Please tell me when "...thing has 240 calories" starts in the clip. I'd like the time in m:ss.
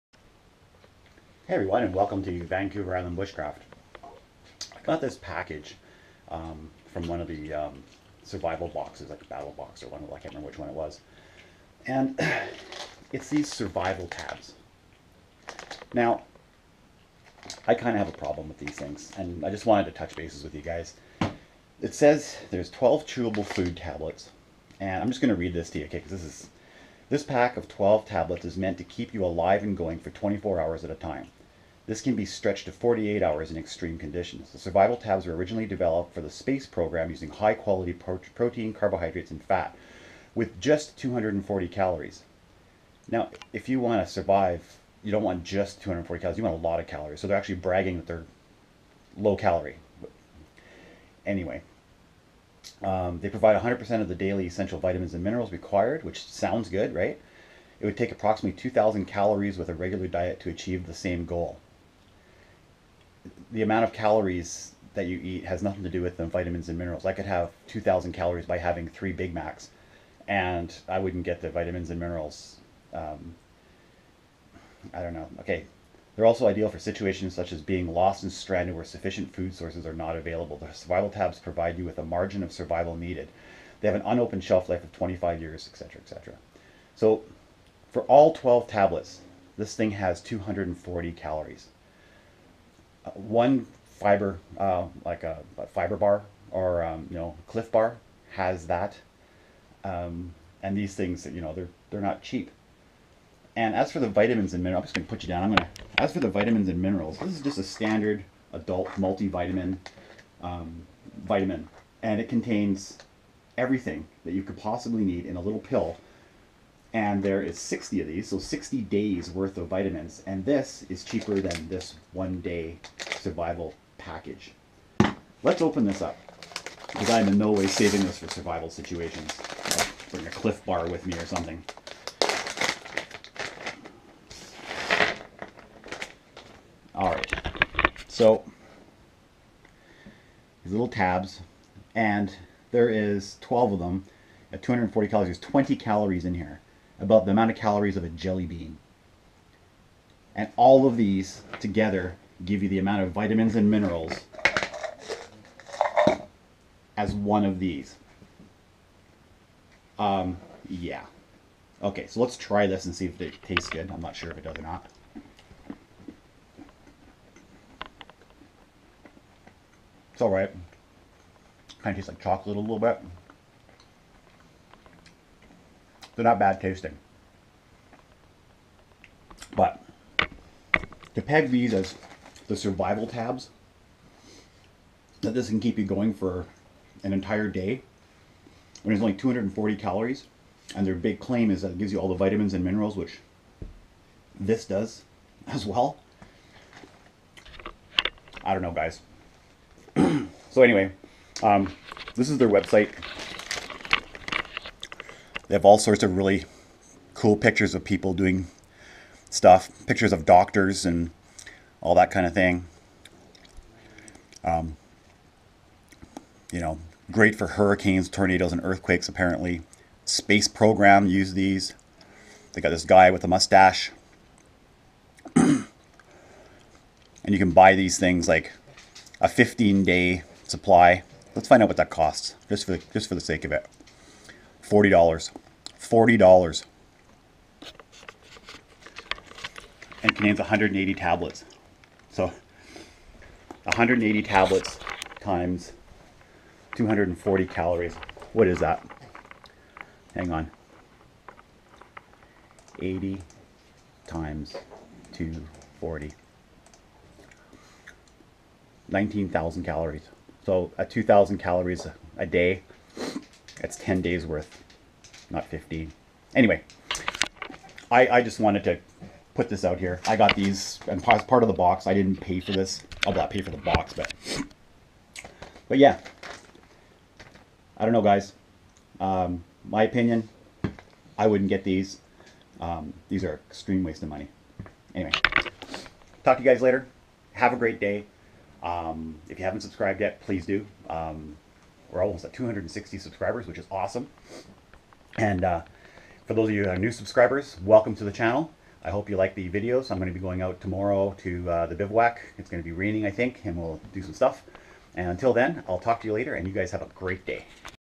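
1:29.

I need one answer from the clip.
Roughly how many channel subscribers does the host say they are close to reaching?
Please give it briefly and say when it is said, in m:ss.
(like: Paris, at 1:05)
260, at 4:52.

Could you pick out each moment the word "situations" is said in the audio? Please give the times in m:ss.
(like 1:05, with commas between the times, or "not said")
1:16, 2:08.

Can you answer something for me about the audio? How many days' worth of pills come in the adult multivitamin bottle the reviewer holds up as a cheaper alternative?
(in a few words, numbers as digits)
60.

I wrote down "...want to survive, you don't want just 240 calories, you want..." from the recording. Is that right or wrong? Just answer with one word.
right.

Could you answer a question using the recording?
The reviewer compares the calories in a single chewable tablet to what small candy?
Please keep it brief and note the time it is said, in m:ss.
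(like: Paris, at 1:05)
A jelly bean, at 2:28.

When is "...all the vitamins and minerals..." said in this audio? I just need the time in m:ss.
3:11.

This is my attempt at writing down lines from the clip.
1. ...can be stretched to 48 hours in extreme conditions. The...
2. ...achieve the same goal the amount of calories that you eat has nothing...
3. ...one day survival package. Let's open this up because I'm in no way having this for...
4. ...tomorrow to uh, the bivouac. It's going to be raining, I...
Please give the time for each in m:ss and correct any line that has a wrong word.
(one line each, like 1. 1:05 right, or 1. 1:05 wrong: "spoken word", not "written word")
1. 0:32 right
2. 1:00 right
3. 2:02 wrong: "saving", not "having"
4. 5:00 right.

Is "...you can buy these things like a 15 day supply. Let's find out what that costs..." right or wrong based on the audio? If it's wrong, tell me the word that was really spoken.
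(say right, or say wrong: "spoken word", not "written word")
right.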